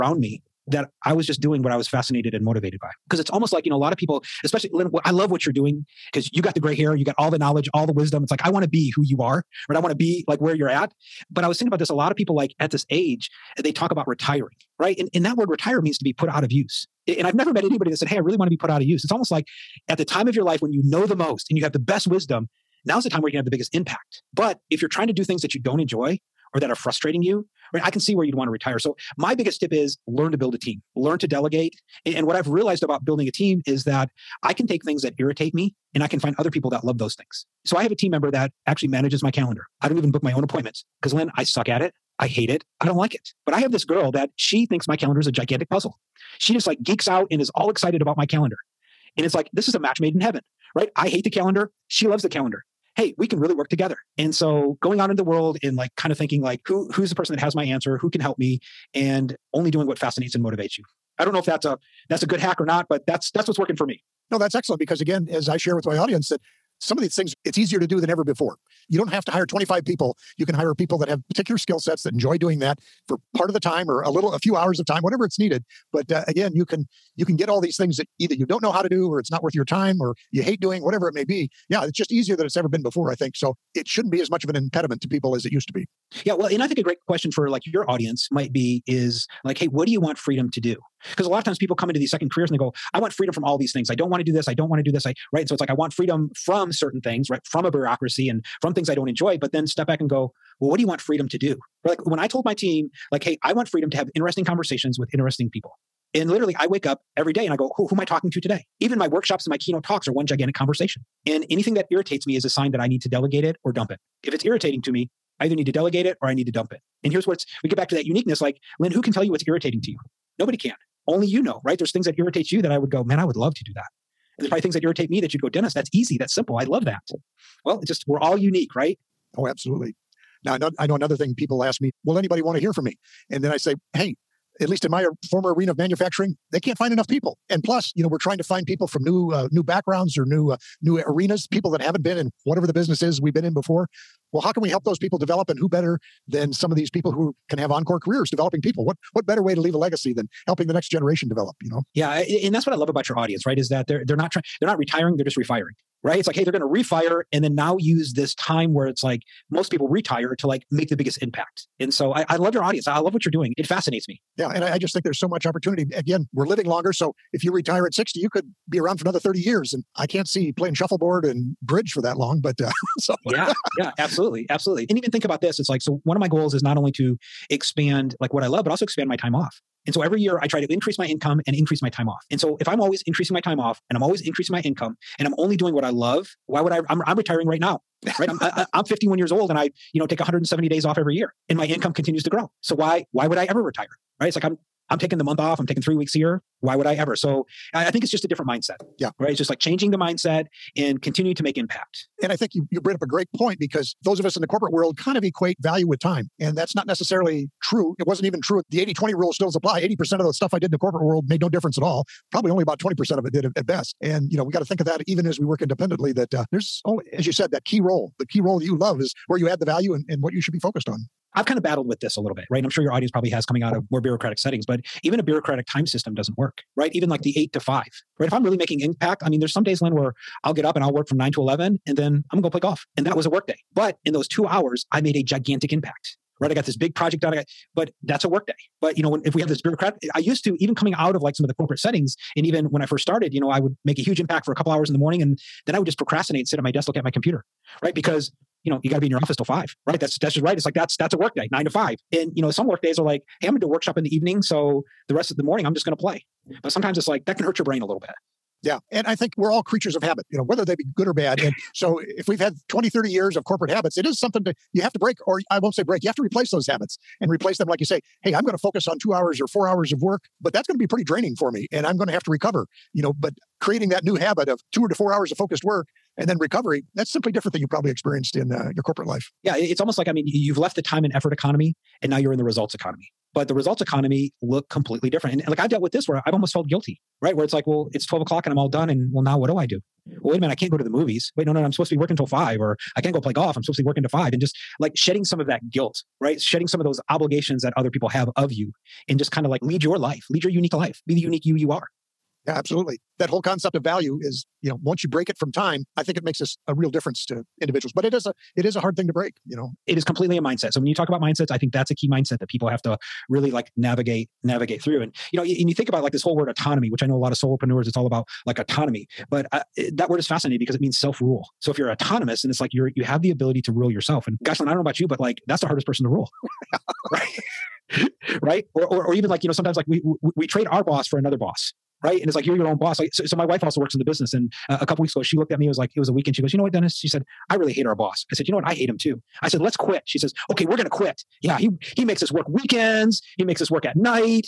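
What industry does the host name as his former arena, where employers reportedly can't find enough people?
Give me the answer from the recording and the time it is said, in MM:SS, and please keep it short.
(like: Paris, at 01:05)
Manufacturing, at 02:15.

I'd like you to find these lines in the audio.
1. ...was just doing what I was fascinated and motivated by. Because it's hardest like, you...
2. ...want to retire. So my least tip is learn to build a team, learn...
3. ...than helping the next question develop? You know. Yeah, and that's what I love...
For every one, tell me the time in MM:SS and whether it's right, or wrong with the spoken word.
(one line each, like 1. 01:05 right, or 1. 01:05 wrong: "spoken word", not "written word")
1. 00:01 wrong: "almost", not "hardest"
2. 00:28 wrong: "biggest", not "least"
3. 02:30 wrong: "generation", not "question".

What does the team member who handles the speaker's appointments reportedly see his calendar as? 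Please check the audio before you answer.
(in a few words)
A gigantic puzzle.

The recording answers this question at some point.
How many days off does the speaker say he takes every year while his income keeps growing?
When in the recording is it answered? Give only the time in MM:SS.
03:10.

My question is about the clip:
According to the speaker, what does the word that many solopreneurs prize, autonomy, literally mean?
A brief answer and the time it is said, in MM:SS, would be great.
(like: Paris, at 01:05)
Self rule, at 05:20.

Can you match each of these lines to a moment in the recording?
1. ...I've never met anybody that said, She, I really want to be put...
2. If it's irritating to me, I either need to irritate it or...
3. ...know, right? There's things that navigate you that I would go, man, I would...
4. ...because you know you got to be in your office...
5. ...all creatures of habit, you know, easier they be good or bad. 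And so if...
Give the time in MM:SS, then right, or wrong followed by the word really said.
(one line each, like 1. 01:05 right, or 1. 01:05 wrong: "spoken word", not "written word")
1. 00:17 wrong: "Hey", not "She"
2. 01:54 wrong: "delegate", not "irritate"
3. 02:01 wrong: "irritate", not "navigate"
4. 04:07 right
5. 04:19 wrong: "whether", not "easier".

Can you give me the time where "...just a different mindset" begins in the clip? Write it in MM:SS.
03:18.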